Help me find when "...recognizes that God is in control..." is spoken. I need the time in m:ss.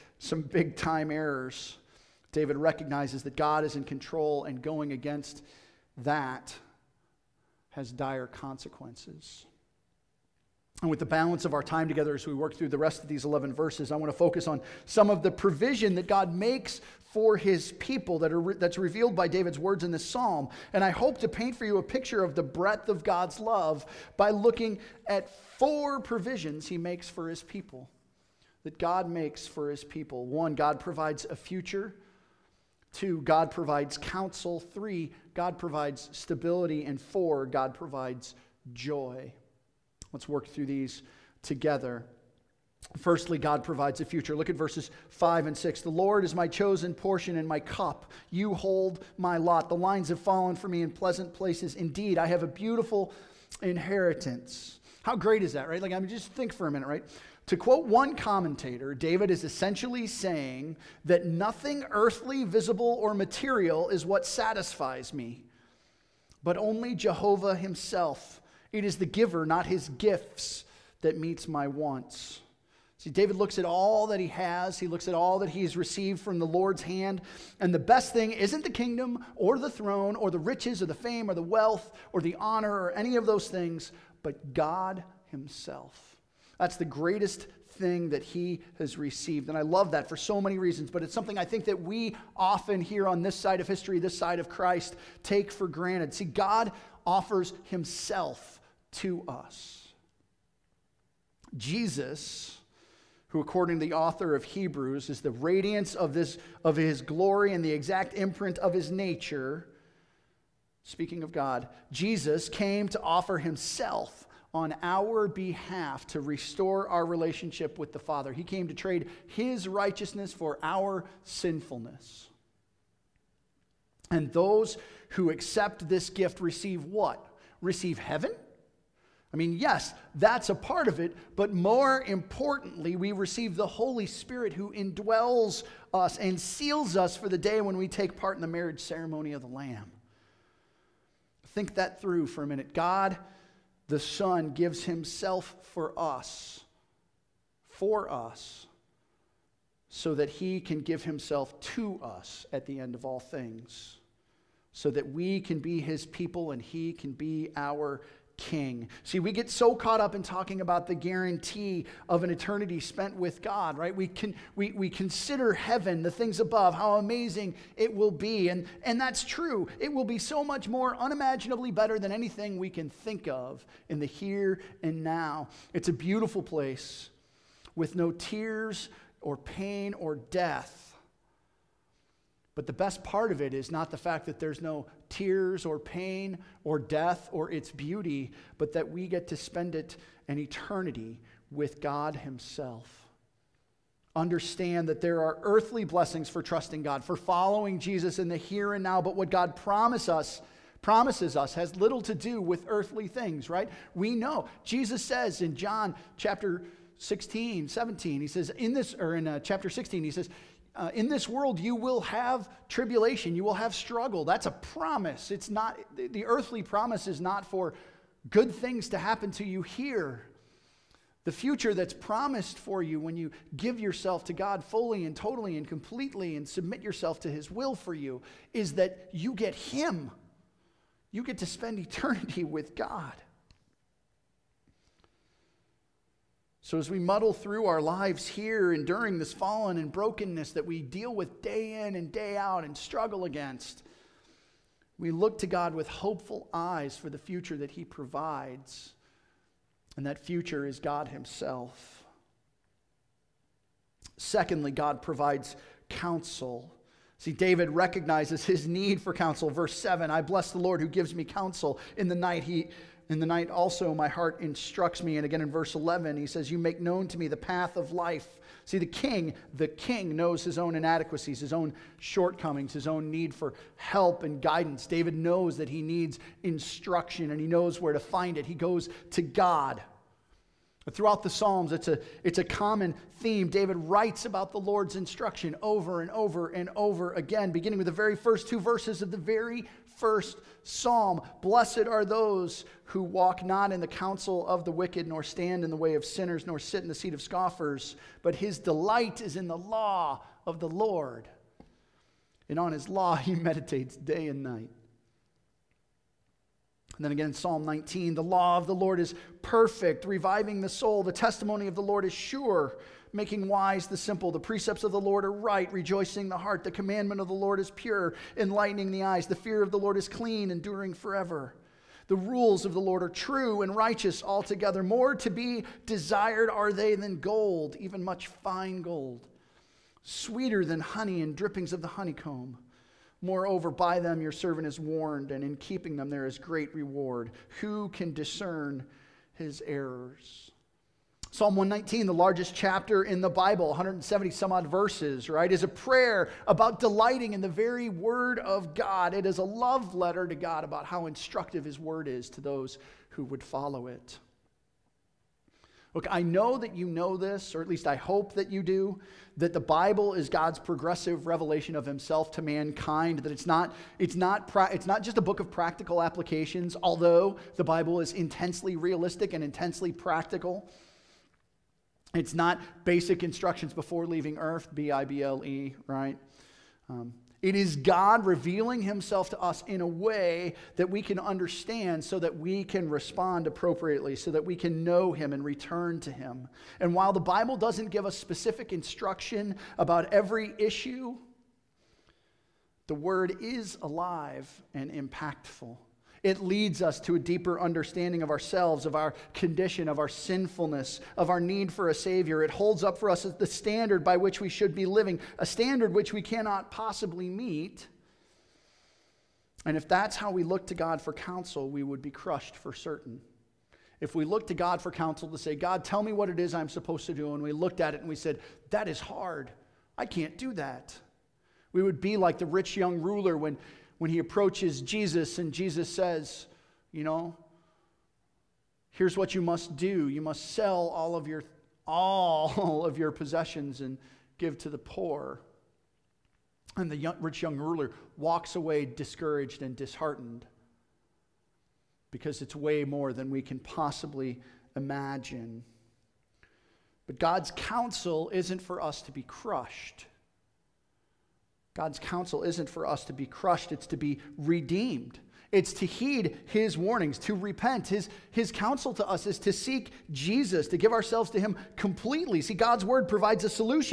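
0:02.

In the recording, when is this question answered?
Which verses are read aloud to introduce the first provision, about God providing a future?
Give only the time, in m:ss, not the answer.
0:44.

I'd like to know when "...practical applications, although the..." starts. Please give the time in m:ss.
6:05.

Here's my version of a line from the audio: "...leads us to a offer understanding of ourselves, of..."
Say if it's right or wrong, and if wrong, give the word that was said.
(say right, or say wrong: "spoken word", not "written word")
wrong: "deeper", not "offer".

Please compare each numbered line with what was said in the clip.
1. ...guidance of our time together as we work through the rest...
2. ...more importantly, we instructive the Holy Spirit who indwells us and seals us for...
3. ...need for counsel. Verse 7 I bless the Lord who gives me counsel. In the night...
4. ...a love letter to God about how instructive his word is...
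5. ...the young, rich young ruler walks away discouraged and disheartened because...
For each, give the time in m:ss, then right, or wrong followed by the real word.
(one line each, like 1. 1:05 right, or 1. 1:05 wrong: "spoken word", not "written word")
1. 0:11 wrong: "balance", not "guidance"
2. 2:11 wrong: "receive", not "instructive"
3. 4:18 right
4. 5:49 right
5. 7:16 right.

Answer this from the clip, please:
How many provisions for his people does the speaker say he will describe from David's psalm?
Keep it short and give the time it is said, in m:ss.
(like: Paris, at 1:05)
4, at 0:25.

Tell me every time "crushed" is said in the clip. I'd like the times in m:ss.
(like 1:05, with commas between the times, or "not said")
6:52, 7:29, 7:33.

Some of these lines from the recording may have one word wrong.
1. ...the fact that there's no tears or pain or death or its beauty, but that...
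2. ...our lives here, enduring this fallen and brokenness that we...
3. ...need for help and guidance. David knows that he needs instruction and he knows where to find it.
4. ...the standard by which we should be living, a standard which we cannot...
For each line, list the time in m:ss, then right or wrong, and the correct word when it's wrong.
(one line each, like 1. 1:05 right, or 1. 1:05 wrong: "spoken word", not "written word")
1. 3:03 right
2. 3:57 right
3. 4:33 right
4. 6:43 right.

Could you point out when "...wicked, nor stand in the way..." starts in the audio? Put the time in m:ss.
4:54.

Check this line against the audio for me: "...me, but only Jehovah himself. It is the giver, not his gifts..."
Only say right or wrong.
right.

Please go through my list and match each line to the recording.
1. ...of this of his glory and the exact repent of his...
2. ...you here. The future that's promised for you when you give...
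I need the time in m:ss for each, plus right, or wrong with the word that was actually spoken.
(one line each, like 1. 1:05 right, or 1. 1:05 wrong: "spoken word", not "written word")
1. 1:45 wrong: "imprint", not "repent"
2. 3:39 right.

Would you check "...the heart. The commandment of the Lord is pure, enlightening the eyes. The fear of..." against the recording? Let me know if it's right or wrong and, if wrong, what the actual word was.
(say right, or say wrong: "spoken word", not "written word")
right.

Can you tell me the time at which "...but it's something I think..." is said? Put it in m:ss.
1:30.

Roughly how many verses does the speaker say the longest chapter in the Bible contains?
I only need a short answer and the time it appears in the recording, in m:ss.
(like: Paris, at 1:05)
170 some odd, at 5:43.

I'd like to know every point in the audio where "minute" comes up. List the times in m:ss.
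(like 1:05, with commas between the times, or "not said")
0:56, 2:22.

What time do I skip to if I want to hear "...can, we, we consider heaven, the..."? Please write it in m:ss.
2:44.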